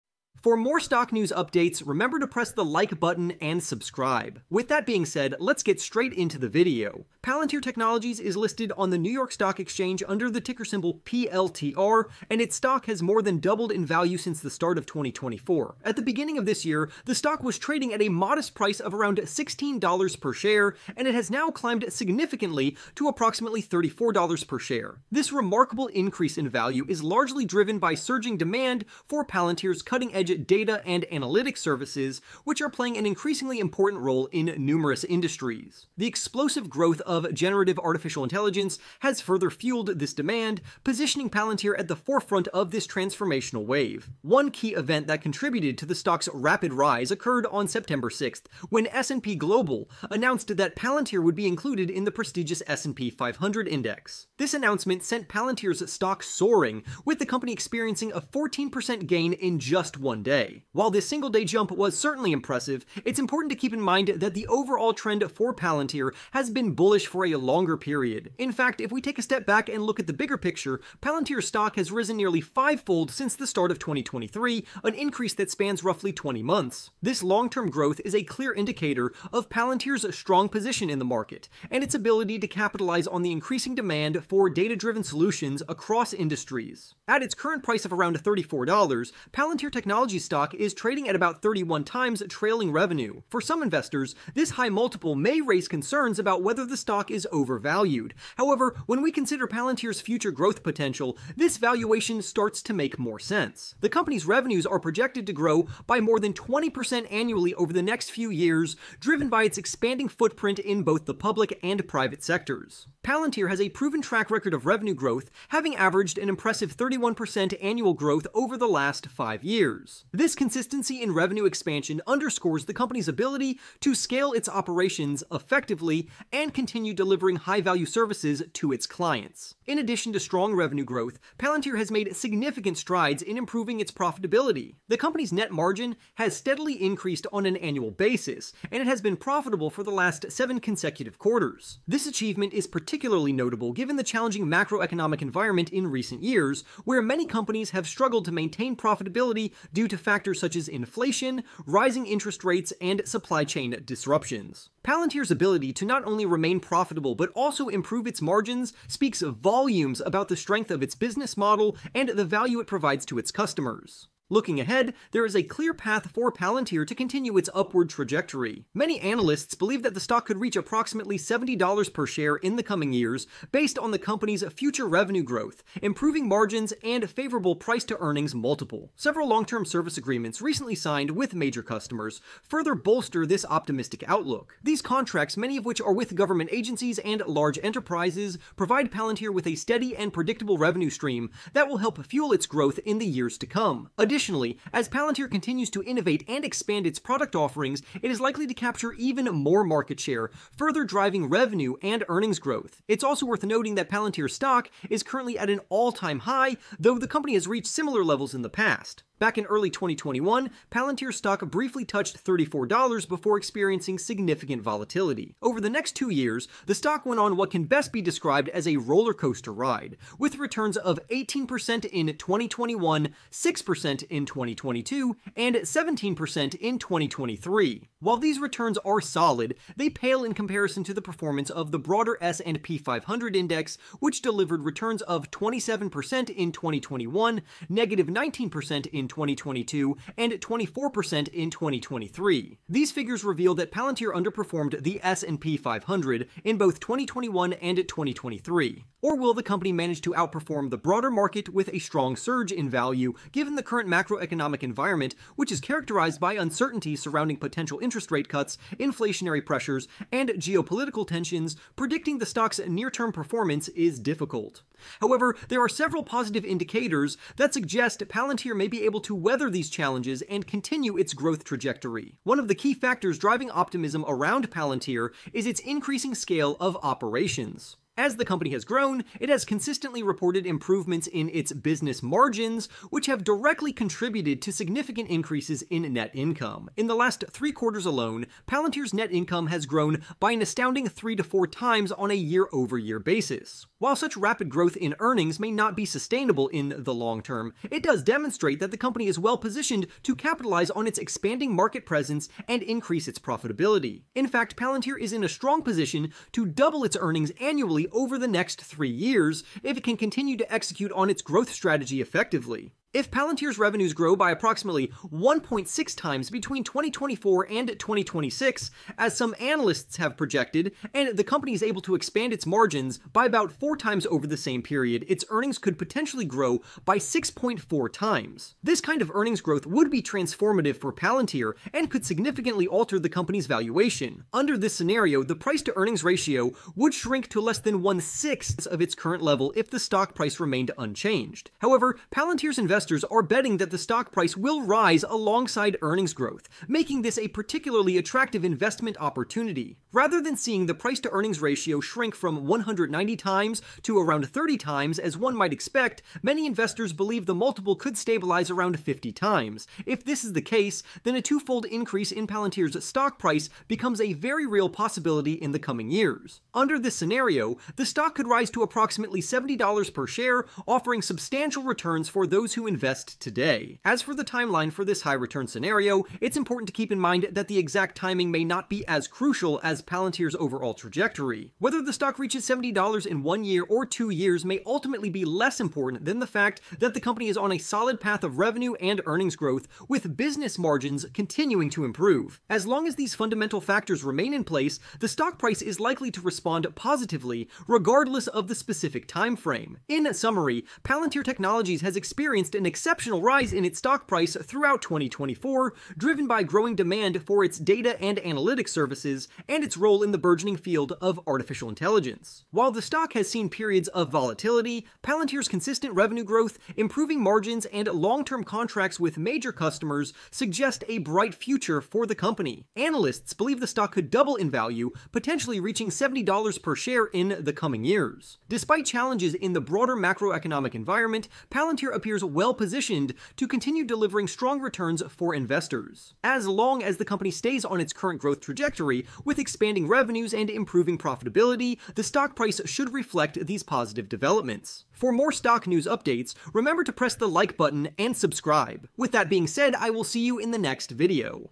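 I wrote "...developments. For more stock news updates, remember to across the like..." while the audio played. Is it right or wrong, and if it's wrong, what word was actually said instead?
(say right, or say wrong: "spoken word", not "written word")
wrong: "press", not "across".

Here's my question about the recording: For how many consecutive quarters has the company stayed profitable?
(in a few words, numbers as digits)
7.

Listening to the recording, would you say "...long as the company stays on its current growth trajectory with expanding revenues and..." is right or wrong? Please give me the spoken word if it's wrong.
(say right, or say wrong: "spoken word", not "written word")
right.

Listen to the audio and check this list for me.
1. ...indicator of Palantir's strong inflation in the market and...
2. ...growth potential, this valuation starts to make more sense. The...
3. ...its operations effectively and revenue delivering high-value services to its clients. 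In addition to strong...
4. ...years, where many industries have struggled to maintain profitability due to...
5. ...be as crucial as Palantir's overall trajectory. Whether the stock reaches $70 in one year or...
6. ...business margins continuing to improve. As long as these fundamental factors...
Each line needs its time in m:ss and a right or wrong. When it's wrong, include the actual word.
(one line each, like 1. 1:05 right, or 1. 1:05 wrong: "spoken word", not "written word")
1. 1:18 wrong: "position", not "inflation"
2. 1:40 right
3. 2:04 wrong: "continue", not "revenue"
4. 2:26 wrong: "companies", not "industries"
5. 6:18 right
6. 6:30 right.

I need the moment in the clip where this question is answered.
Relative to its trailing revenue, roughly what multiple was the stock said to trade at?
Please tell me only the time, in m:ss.
1:31.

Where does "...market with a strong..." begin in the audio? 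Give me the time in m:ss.
4:11.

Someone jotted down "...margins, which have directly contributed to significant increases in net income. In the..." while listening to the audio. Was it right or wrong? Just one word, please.
right.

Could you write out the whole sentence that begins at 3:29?
Back in early 2021, Palantir stock briefly touched $34 before experiencing significant volatility.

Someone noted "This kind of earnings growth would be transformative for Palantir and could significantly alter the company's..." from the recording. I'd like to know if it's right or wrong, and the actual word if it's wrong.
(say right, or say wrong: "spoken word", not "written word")
right.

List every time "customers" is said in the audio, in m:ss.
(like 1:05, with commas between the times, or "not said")
2:43, 3:01, 6:59.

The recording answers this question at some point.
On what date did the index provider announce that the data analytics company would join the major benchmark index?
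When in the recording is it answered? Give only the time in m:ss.
0:47.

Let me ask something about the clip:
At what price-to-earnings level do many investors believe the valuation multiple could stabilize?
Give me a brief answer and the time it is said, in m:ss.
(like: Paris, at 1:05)
50 times, at 5:58.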